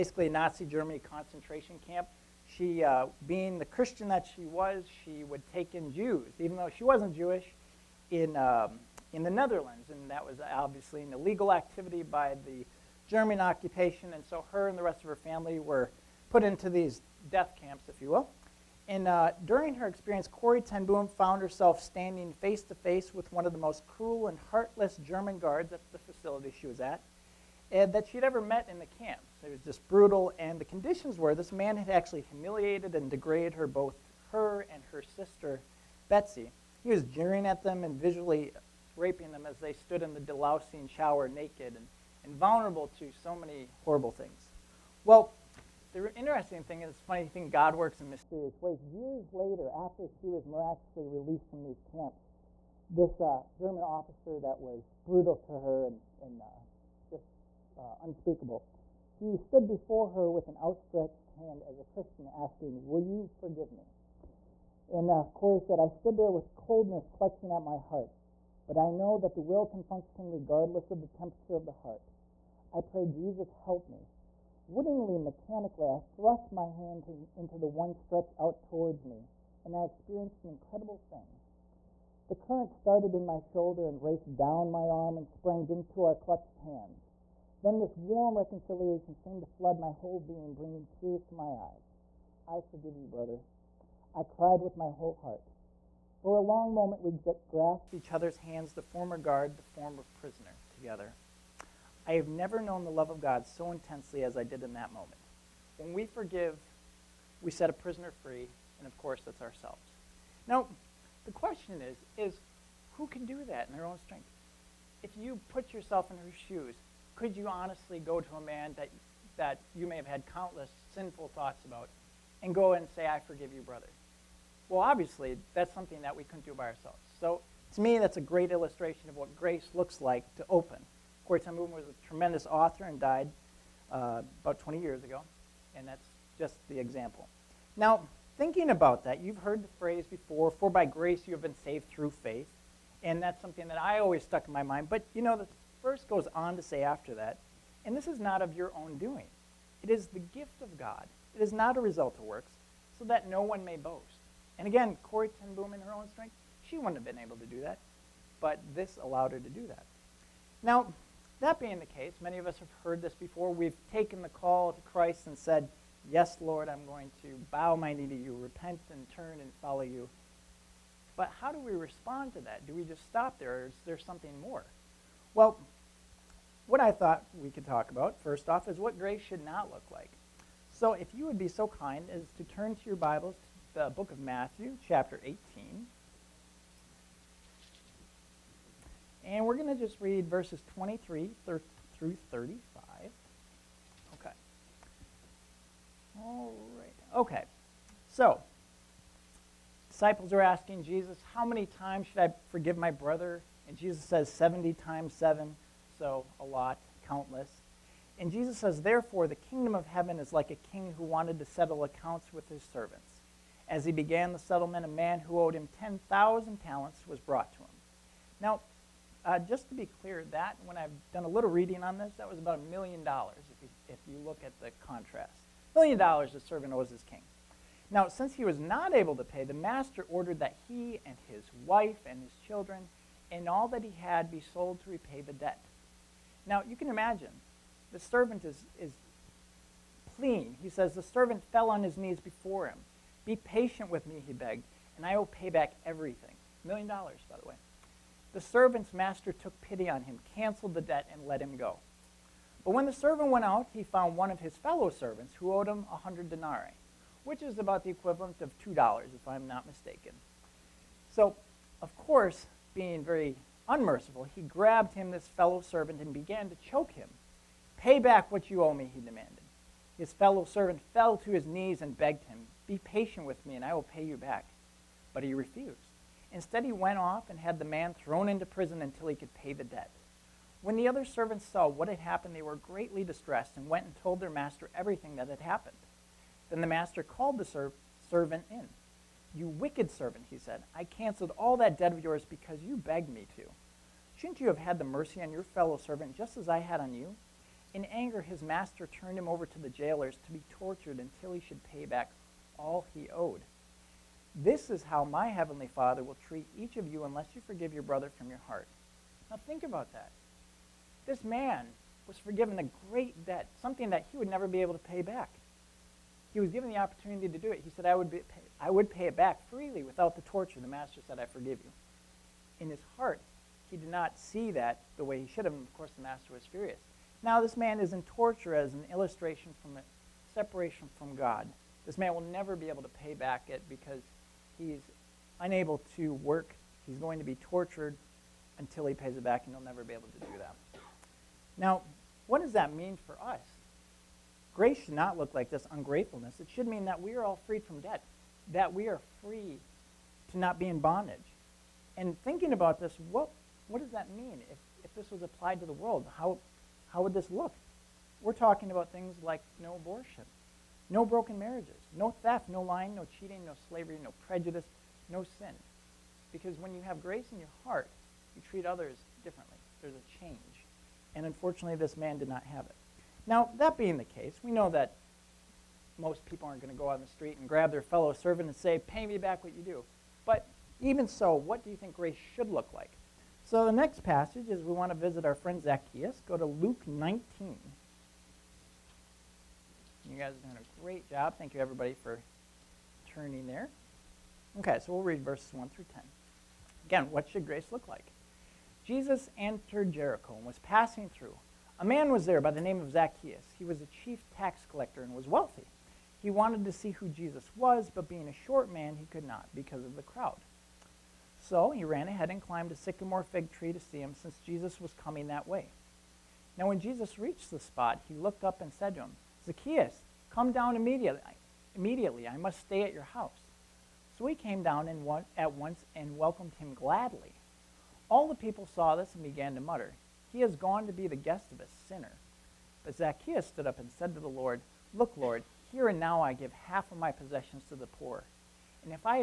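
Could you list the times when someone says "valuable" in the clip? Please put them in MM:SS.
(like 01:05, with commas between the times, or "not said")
not said.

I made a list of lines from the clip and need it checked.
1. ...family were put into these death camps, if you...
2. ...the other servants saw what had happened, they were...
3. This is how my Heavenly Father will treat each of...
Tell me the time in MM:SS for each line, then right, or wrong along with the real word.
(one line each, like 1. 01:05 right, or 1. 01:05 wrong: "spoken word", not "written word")
1. 00:15 right
2. 04:40 right
3. 05:04 right.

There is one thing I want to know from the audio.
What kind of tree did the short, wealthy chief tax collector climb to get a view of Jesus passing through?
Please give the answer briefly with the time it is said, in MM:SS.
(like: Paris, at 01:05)
sycamore fig tree, at 06:52.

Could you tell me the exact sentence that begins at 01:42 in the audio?
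I have never known the love of God so intensely as I did in that moment.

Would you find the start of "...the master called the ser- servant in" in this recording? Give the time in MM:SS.
04:46.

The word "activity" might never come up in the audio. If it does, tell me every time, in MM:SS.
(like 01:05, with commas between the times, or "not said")
00:11.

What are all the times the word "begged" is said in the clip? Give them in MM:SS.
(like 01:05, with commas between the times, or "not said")
04:04, 04:31, 04:52.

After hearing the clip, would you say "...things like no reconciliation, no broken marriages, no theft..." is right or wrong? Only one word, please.
wrong.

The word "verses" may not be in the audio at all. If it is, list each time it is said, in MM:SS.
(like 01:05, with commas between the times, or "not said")
02:25, 03:10, 06:35.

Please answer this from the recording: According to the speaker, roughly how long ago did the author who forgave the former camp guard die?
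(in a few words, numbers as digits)
about 20 years ago.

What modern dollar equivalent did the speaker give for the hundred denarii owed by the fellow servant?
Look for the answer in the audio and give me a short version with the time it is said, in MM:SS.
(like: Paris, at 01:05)
2 dollars, at 04:18.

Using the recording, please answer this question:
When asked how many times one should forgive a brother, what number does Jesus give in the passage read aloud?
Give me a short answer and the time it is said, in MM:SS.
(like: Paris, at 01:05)
70 times 7, at 03:24.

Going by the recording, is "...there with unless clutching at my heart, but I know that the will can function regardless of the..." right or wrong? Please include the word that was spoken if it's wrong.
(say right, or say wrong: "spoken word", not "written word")
wrong: "coldness", not "unless".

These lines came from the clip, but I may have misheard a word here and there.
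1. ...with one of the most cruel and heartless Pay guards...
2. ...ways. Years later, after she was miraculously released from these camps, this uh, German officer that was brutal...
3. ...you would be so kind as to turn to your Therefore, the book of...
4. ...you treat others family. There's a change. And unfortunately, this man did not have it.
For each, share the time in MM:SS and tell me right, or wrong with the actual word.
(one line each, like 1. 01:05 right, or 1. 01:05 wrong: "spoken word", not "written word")
1. 00:23 wrong: "German", not "Pay"
2. 00:48 right
3. 03:01 wrong: "Bibles", not "Therefore"
4. 06:08 wrong: "differently", not "family".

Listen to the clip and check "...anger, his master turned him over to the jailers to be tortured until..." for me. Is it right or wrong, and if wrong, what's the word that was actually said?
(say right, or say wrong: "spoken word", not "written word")
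right.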